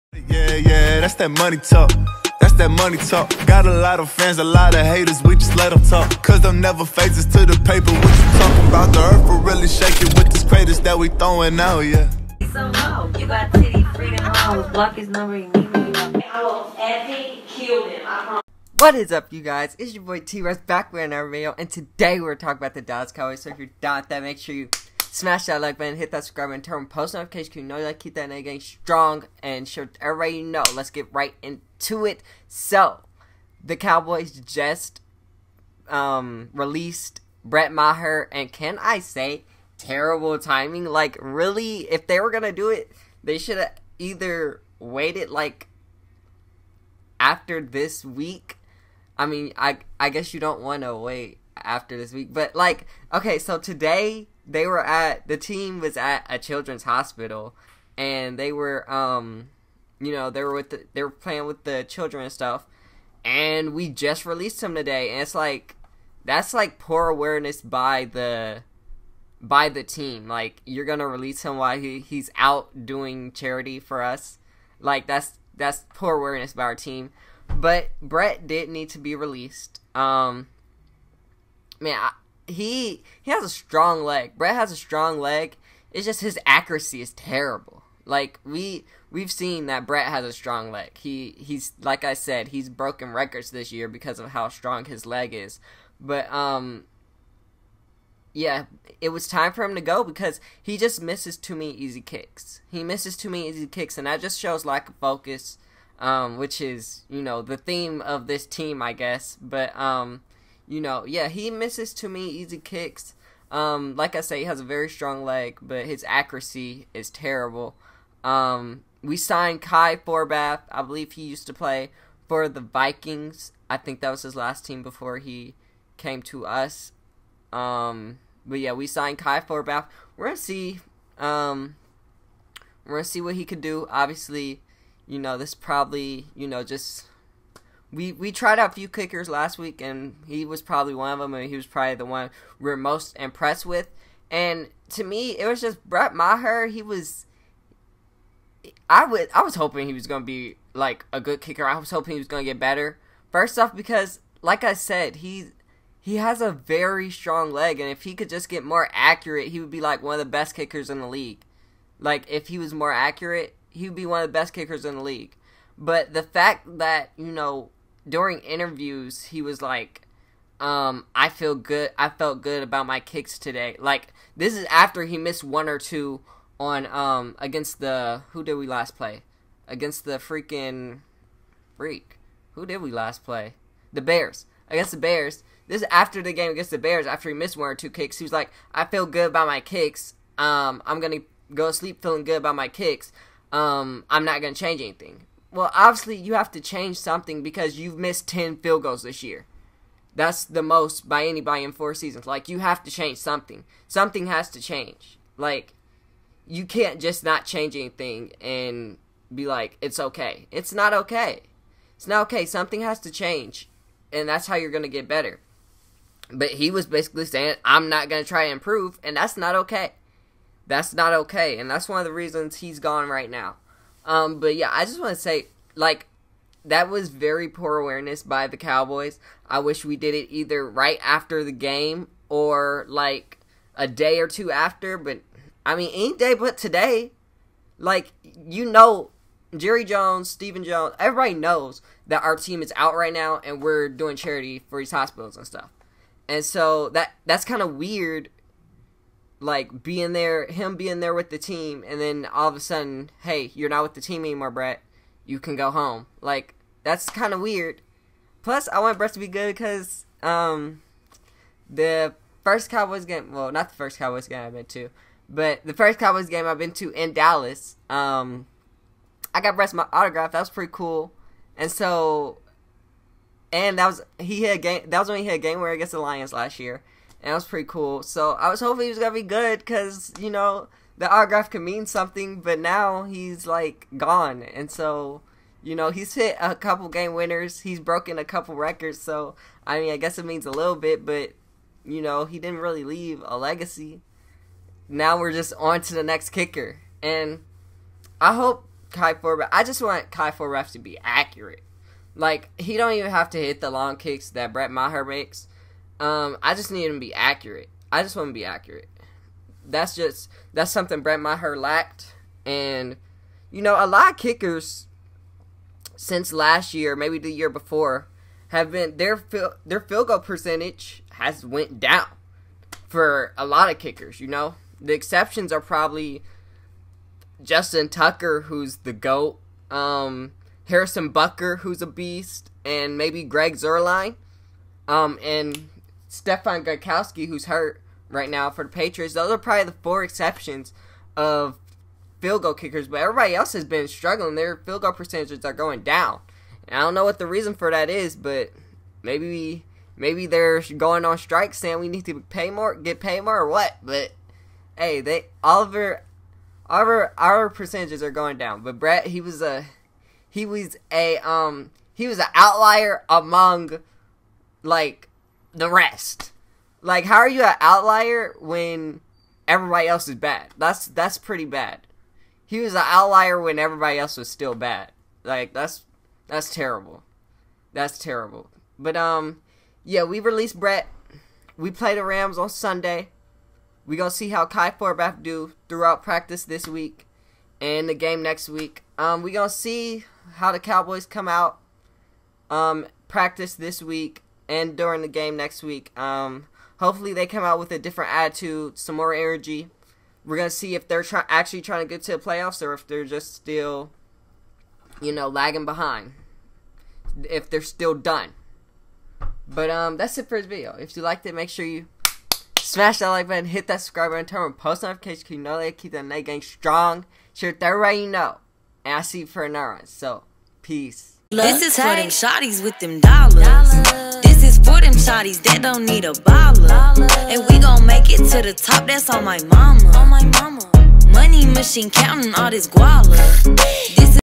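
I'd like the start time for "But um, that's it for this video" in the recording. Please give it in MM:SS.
06:49.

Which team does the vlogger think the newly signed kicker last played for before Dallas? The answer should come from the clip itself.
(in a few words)
Vikings.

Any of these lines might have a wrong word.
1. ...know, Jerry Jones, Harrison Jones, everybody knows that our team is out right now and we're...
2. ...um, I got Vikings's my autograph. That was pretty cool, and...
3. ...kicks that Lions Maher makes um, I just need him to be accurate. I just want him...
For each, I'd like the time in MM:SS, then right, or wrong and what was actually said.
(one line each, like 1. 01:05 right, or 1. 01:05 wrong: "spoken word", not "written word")
1. 03:58 wrong: "Stephen", not "Harrison"
2. 04:27 wrong: "Brett", not "Vikings"
3. 05:03 wrong: "Brett", not "Lions".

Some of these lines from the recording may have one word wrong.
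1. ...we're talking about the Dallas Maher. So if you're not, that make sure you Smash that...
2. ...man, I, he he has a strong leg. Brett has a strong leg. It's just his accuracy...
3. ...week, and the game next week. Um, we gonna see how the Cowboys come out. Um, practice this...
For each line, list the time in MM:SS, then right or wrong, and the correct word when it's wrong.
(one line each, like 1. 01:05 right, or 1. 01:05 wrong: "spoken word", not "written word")
1. 00:22 wrong: "Cowboys", not "Maher"
2. 01:21 right
3. 06:26 right.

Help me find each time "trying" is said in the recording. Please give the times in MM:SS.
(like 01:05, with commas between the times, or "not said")
06:41.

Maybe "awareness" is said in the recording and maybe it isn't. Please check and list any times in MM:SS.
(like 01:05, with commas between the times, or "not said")
01:07, 01:16, 03:47.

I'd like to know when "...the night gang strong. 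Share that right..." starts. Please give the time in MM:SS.
06:55.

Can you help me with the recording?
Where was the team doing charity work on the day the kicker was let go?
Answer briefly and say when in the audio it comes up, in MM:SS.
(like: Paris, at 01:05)
Children's hospital, at 00:56.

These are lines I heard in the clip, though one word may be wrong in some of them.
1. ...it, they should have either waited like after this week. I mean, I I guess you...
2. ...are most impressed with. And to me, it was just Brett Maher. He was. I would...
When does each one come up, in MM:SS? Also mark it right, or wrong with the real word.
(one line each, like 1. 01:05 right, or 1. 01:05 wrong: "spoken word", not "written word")
1. 00:42 right
2. 02:22 right.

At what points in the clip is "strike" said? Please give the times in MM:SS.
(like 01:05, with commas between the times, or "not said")
05:51.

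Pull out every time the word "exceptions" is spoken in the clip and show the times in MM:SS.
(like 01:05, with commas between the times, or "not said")
05:24, 05:40.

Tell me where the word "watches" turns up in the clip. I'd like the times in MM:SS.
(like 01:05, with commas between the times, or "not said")
not said.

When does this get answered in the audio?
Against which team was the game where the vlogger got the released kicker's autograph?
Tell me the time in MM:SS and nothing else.
04:35.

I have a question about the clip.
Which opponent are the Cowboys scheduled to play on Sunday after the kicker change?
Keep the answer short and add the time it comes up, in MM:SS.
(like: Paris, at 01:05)
The Rams, at 06:21.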